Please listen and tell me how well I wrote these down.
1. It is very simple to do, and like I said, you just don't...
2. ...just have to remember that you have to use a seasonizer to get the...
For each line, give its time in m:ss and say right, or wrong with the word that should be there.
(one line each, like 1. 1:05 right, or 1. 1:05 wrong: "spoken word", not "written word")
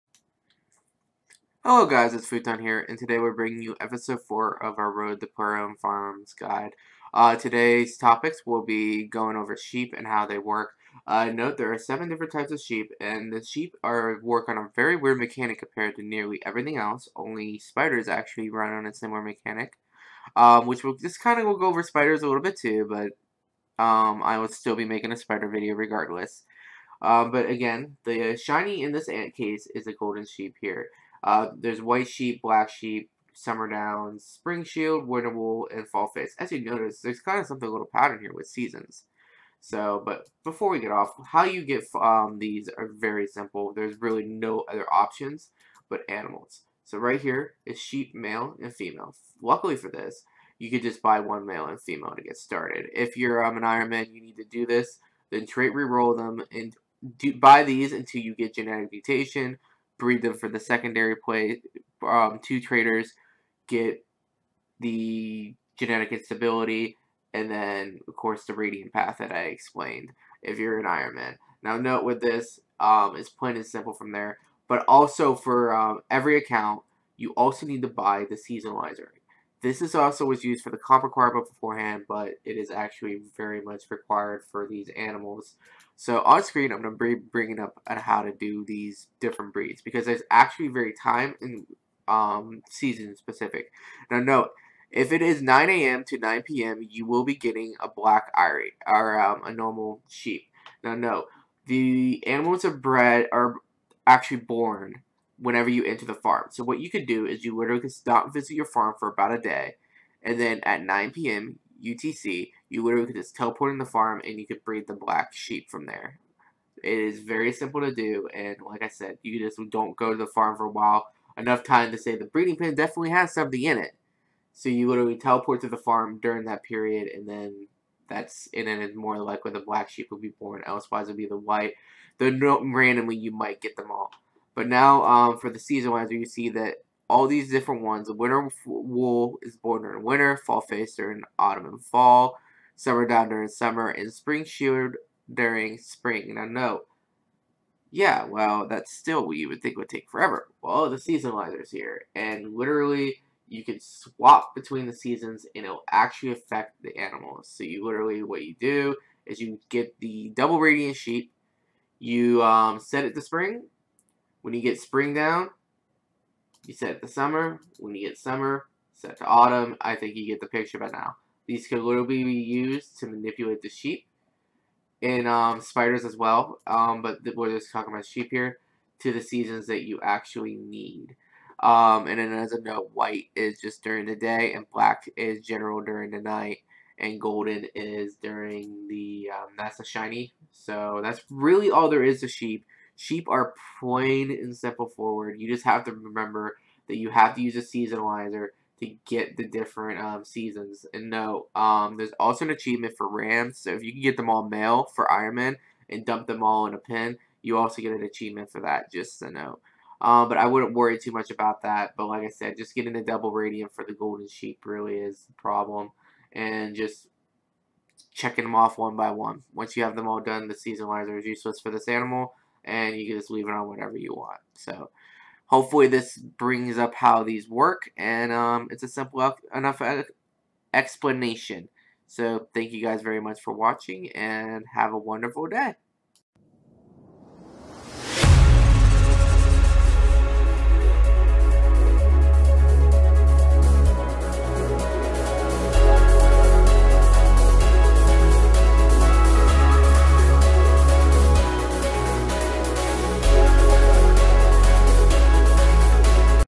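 1. 1:56 right
2. 3:15 right.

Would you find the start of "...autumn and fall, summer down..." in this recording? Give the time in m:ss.
2:21.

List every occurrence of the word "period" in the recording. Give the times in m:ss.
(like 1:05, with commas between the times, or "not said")
2:06.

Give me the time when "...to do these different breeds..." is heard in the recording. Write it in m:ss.
1:28.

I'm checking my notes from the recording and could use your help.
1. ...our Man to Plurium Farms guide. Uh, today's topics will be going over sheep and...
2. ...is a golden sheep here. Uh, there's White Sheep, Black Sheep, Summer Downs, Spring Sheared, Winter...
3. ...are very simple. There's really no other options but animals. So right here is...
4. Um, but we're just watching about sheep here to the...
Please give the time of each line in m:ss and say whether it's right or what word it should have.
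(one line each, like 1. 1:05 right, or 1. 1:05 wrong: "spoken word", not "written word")
1. 0:04 wrong: "Road", not "Man"
2. 0:29 right
3. 0:42 right
4. 2:56 wrong: "talking", not "watching".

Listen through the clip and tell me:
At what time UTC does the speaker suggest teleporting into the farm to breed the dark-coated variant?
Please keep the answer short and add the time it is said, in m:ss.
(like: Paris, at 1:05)
9 p.m., at 1:50.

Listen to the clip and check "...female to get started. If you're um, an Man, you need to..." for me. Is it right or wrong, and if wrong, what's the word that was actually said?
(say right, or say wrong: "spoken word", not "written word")
right.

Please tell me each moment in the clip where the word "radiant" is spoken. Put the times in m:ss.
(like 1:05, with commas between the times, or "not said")
1:08, 2:40, 3:33.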